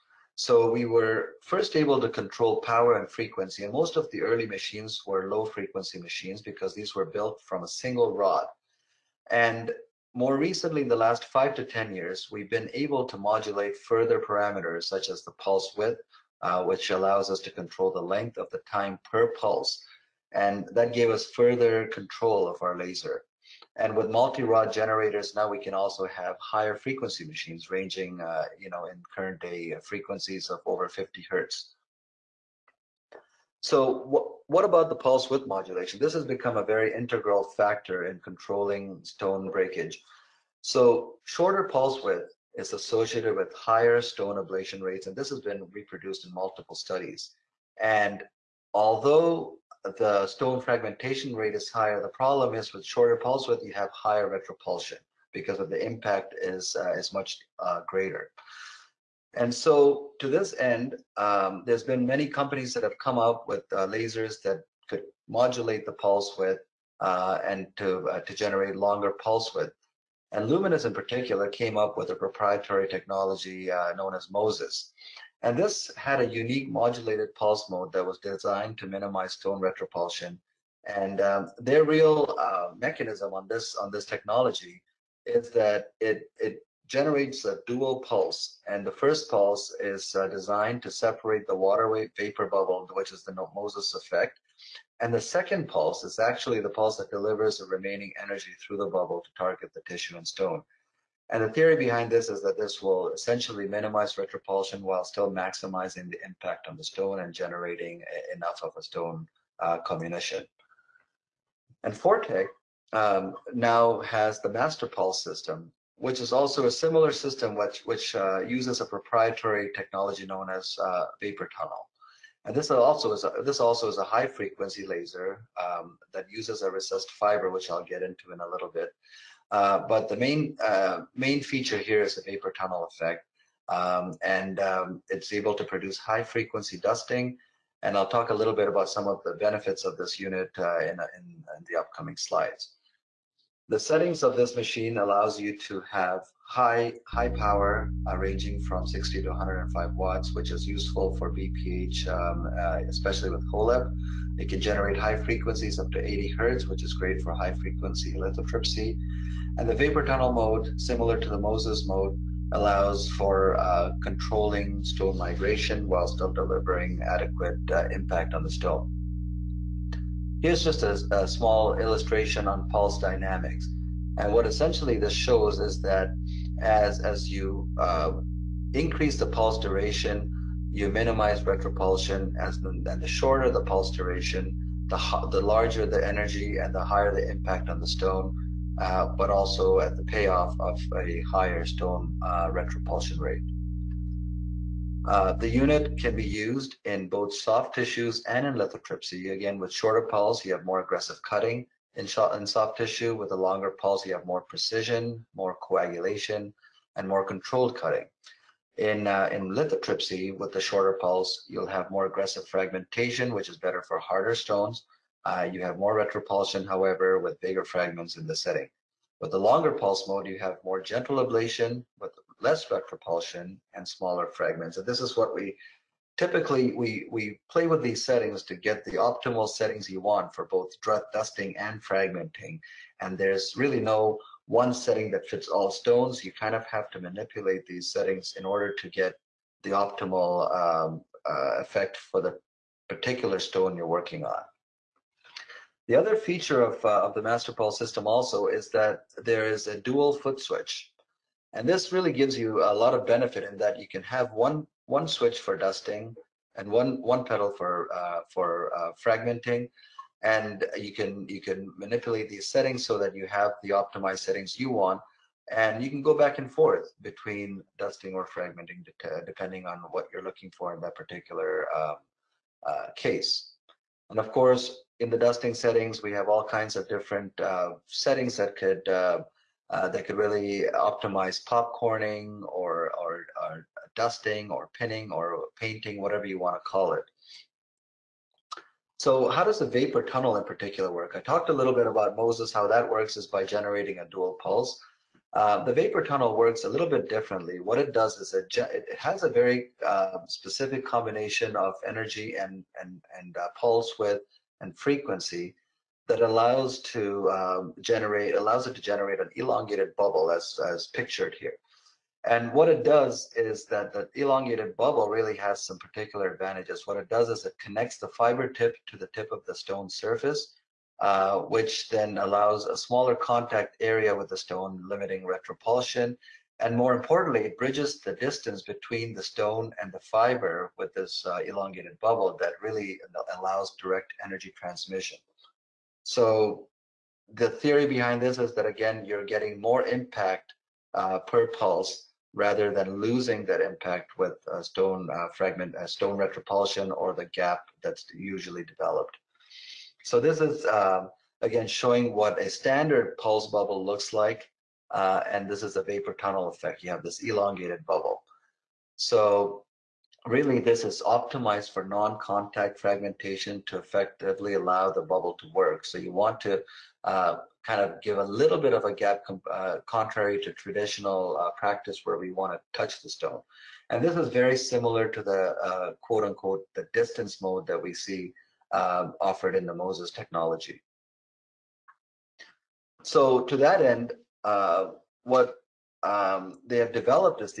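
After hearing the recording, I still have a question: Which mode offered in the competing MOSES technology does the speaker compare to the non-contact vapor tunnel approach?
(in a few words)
distance mode.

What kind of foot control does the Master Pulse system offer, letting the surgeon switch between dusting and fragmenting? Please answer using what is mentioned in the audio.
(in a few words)
dual foot switch.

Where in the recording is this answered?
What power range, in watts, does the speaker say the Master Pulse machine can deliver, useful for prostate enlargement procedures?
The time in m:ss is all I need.
2:28.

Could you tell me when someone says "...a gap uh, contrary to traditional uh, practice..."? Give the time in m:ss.
6:08.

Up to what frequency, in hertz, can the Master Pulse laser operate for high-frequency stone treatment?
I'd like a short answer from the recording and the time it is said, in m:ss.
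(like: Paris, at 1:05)
80 hertz, at 2:36.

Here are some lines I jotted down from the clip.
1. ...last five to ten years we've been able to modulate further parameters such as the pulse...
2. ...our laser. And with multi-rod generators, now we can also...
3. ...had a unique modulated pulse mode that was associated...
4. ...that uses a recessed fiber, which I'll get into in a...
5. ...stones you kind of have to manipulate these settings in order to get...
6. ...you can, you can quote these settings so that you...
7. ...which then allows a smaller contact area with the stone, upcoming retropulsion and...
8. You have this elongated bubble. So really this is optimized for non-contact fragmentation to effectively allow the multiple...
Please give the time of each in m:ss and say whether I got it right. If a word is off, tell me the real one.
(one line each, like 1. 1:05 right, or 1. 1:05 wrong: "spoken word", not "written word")
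1. 0:11 right
2. 0:22 right
3. 1:15 wrong: "designed", not "associated"
4. 2:06 right
5. 3:55 right
6. 4:20 wrong: "manipulate", not "quote"
7. 5:21 wrong: "limiting", not "upcoming"
8. 5:56 wrong: "bubble", not "multiple".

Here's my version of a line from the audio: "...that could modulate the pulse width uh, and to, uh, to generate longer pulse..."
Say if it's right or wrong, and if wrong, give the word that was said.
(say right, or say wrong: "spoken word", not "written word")
right.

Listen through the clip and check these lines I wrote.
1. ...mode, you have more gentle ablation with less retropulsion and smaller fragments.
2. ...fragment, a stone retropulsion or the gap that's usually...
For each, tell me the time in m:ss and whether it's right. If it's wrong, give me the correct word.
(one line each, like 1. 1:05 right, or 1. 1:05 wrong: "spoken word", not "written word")
1. 3:40 right
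2. 5:45 right.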